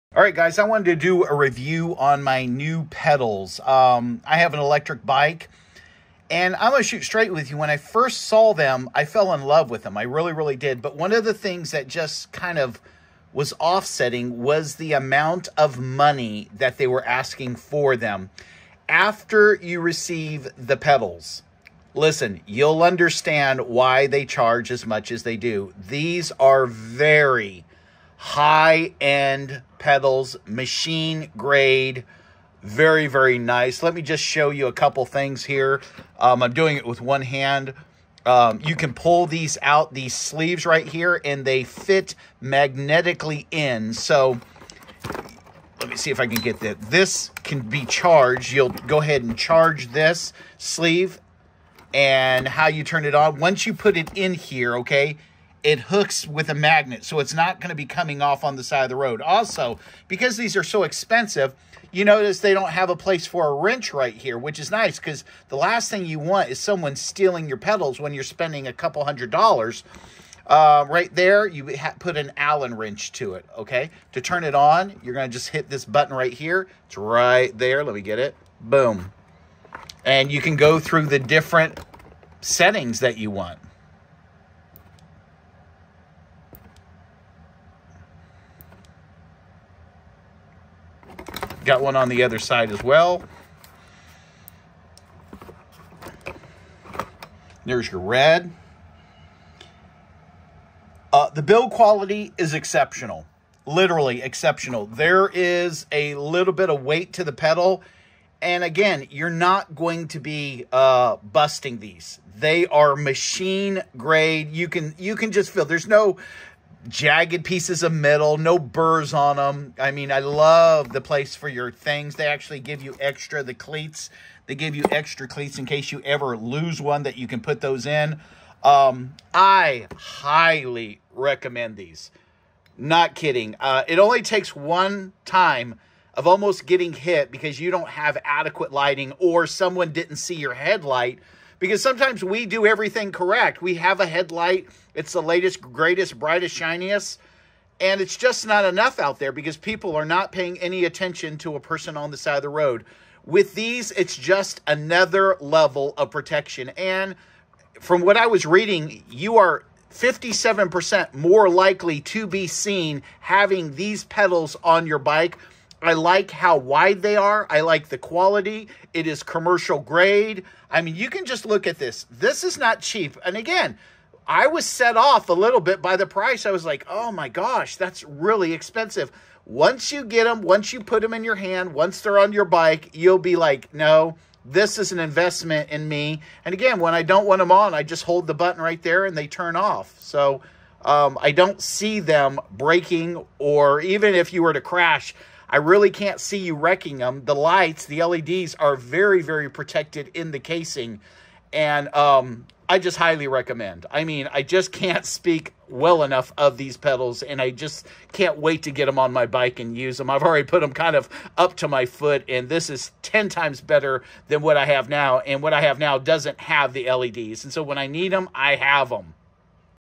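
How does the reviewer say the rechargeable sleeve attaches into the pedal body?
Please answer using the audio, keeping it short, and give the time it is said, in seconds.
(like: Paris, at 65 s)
Magnetically, at 42 s.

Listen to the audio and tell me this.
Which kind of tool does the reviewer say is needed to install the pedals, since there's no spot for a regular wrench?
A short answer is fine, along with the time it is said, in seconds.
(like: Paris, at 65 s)
Allen wrench, at 72 s.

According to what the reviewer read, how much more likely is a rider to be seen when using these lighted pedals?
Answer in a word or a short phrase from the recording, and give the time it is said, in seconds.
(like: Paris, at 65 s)
57%, at 159 s.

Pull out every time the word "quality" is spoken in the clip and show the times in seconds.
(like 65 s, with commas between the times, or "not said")
101 s, 167 s.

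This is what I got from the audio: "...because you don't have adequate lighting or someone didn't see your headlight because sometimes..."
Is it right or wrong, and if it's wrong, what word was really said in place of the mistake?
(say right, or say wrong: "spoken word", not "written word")
right.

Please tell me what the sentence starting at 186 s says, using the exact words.
And again, when I don't want them on, I just hold the button right there and they turn off.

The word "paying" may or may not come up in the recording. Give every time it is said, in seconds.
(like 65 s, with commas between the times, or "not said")
150 s.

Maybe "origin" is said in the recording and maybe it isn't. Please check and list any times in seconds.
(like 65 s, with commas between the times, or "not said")
not said.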